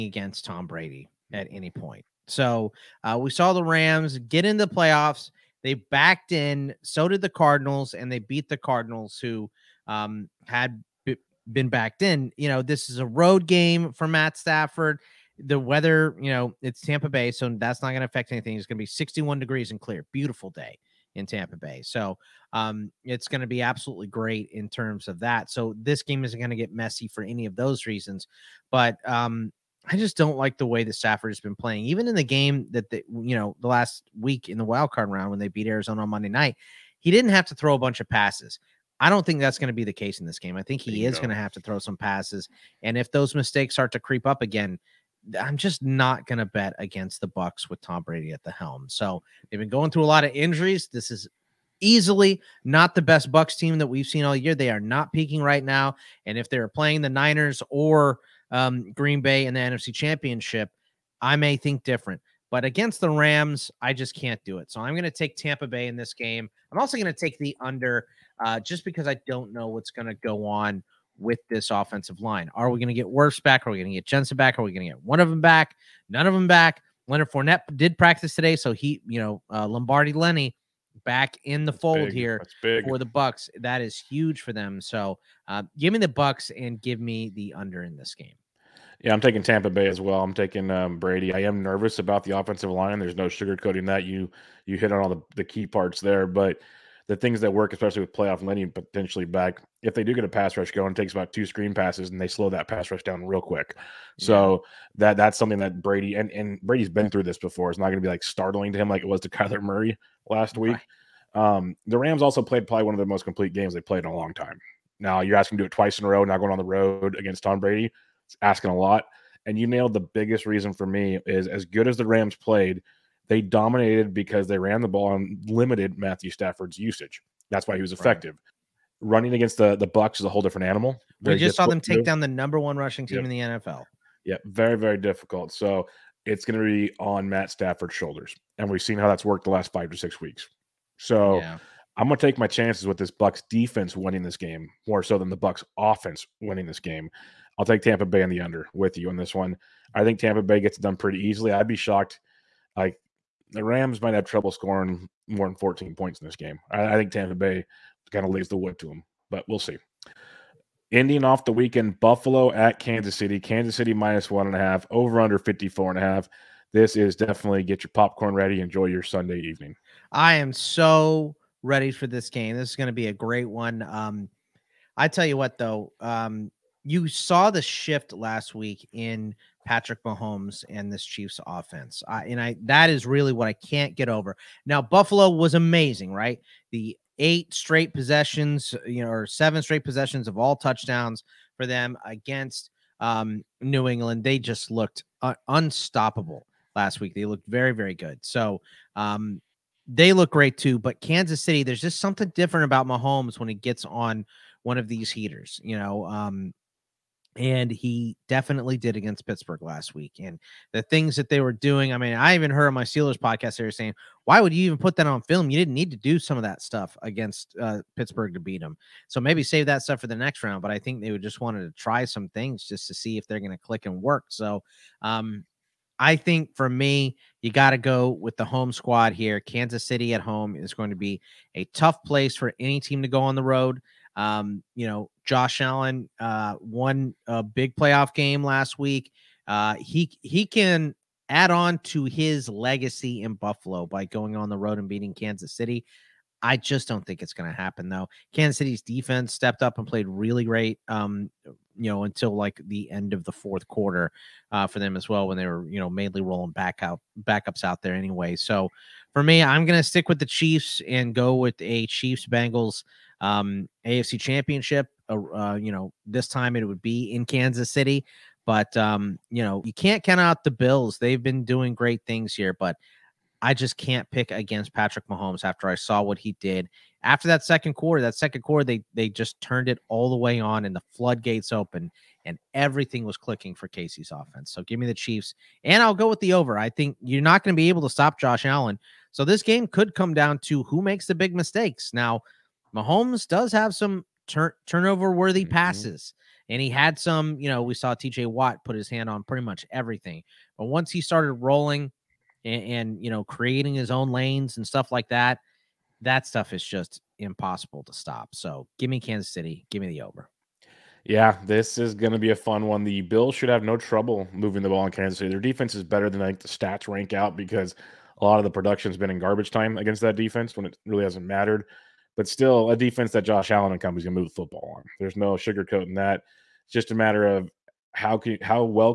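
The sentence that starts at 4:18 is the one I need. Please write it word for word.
So for me, I'm going to stick with the Chiefs and go with a Chiefs Bengals um, AFC Championship.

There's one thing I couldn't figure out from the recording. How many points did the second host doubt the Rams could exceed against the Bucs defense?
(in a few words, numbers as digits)
14.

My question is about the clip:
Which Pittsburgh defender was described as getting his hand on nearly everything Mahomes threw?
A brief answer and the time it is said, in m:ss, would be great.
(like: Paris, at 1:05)
TJ Watt, at 4:57.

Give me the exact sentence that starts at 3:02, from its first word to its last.
I, and I that is really what I can't get over.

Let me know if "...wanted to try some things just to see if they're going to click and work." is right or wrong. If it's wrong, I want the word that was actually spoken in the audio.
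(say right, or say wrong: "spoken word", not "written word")
right.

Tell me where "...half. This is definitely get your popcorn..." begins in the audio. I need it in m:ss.
2:46.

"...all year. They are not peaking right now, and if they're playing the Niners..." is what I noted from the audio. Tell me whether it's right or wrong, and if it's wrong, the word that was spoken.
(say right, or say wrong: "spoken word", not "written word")
right.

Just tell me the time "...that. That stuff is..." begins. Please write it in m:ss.
5:05.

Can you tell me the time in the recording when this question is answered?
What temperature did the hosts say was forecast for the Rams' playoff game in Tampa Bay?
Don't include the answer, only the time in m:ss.
0:18.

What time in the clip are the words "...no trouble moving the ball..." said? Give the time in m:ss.
5:13.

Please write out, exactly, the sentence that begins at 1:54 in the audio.
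Now you're asking to do it twice in a row, not going on the road against Tom Brady.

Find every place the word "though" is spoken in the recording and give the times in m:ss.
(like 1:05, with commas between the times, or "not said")
2:55, 4:07.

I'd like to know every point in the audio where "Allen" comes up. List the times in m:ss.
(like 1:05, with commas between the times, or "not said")
3:55, 4:48, 5:23.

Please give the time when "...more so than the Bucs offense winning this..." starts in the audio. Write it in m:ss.
2:24.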